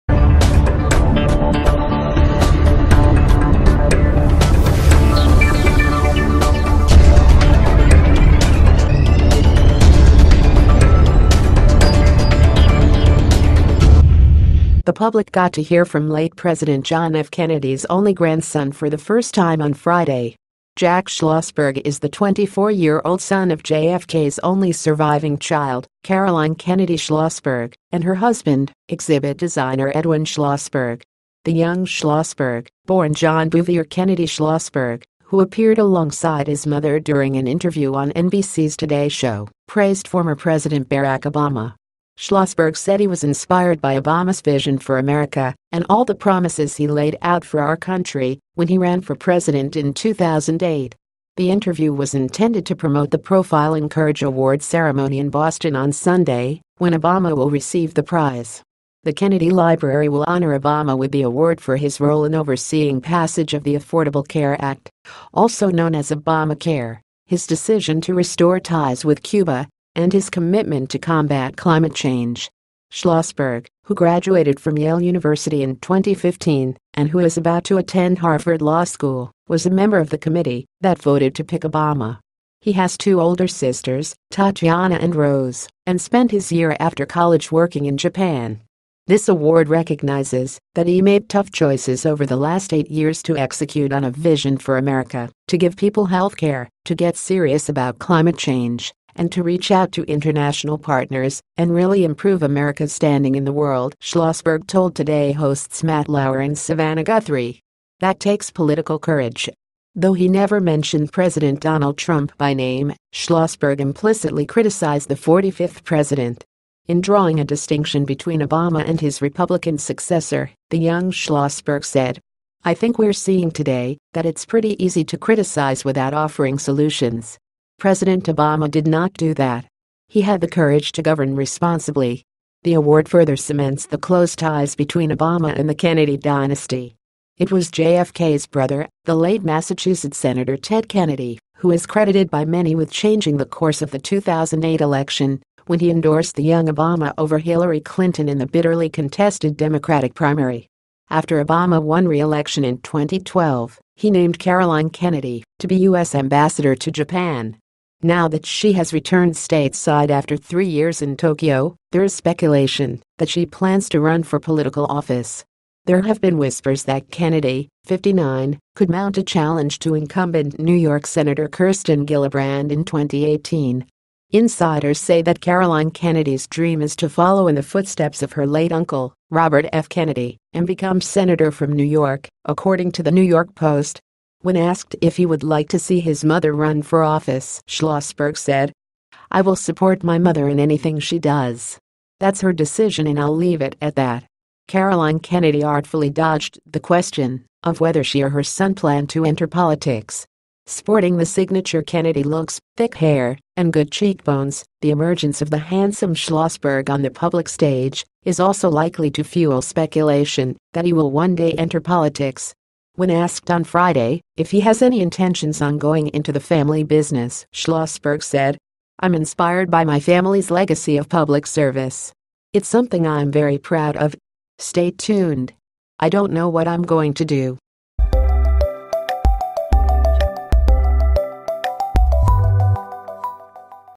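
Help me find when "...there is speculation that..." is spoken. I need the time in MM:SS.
02:41.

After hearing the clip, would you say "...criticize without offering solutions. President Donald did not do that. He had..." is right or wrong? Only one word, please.
wrong.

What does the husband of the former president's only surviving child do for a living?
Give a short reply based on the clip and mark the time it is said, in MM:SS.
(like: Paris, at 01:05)
exhibit designer, at 00:28.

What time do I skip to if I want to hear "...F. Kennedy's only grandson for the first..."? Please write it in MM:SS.
00:17.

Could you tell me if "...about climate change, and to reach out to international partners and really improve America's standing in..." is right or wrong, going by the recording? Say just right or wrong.
right.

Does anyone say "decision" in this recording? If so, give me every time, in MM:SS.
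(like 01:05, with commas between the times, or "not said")
01:07, 03:12.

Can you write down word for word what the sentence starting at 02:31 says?
After Obama won re-election in 2012, he named Caroline Kennedy to be U.S.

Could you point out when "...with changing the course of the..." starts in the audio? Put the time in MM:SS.
02:22.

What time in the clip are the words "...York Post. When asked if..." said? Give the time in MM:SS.
03:03.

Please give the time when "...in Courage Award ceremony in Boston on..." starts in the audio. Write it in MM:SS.
00:53.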